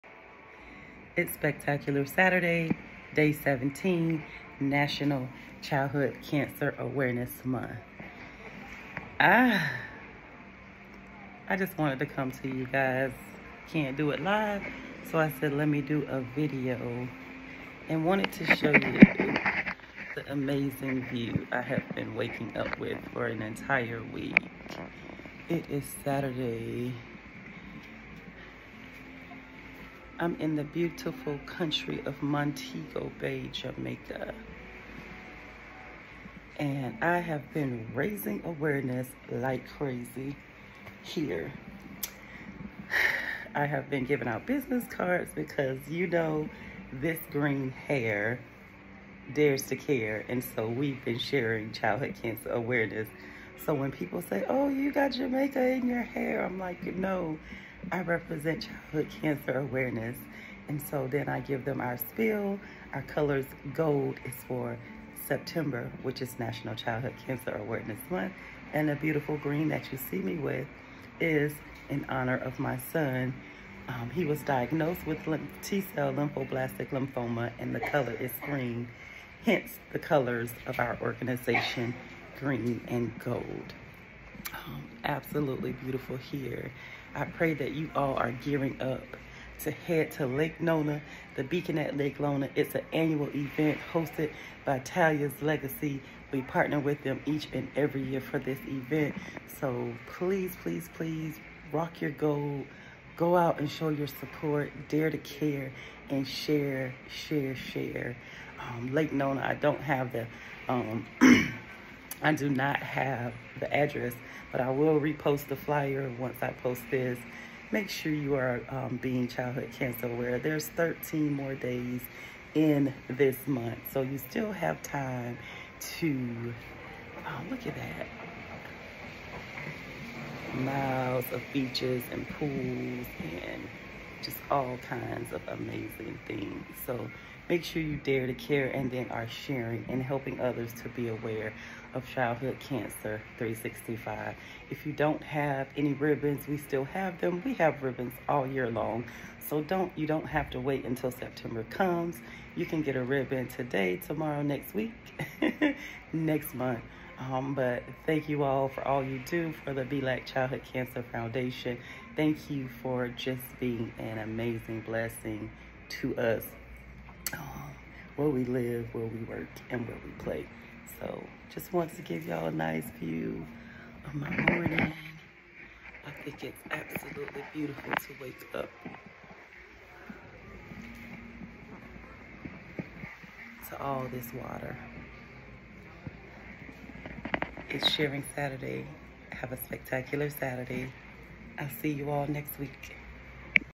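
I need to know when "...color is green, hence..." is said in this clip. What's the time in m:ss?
1:17.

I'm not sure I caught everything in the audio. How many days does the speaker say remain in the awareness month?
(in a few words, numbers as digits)
13.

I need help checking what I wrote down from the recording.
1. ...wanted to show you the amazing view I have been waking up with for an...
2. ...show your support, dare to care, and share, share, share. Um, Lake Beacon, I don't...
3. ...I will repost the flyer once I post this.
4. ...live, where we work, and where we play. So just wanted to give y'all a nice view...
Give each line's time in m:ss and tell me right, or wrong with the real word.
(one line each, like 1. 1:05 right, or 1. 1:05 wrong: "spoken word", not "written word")
1. 0:18 right
2. 1:43 wrong: "Nona", not "Beacon"
3. 1:54 right
4. 2:48 right.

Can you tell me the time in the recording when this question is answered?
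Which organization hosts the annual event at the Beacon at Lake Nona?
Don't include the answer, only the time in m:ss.
1:34.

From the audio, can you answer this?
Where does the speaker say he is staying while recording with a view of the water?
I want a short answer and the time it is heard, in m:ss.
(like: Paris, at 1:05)
Montego Bay, Jamaica, at 0:32.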